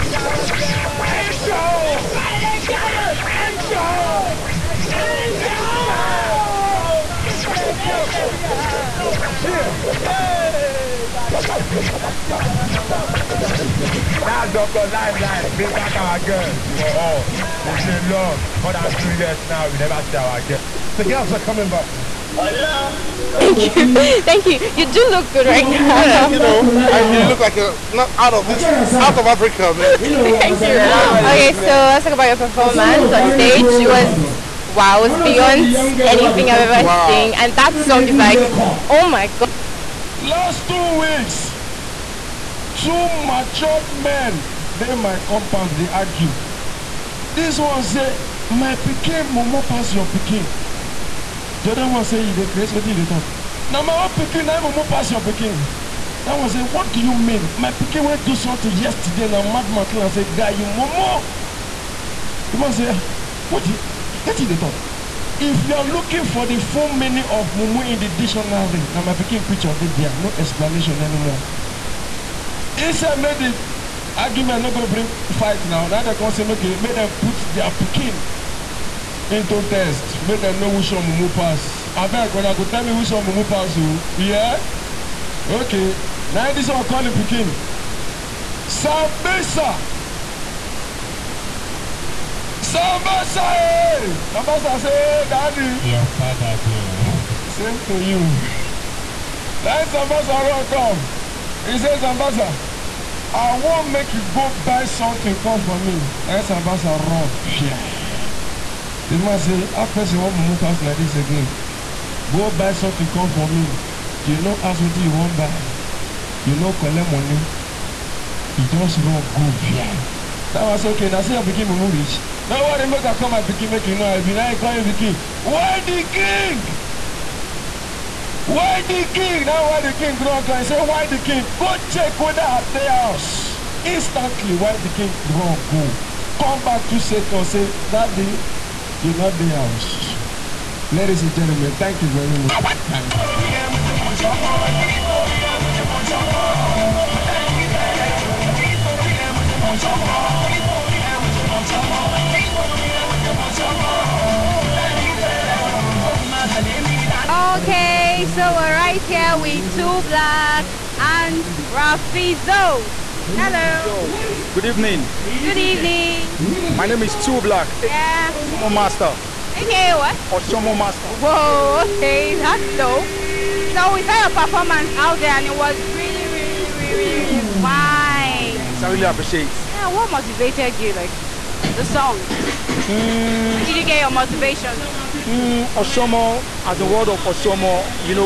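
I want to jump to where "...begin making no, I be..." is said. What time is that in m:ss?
2:03.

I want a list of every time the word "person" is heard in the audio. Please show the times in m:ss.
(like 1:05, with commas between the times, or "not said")
1:49.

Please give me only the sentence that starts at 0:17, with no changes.
It's a long, more than two years now, we never see our girls.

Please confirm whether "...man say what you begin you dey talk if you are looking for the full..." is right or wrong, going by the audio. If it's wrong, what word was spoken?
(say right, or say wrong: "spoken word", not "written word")
wrong: "wetin", not "begin".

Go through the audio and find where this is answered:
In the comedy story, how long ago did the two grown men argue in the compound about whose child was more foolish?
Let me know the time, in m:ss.
0:40.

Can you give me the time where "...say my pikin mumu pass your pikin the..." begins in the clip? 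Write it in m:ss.
0:47.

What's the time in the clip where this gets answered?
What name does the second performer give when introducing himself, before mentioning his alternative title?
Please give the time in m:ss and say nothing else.
2:47.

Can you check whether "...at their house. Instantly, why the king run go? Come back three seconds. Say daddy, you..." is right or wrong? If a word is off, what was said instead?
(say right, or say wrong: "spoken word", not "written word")
wrong: "two", not "three".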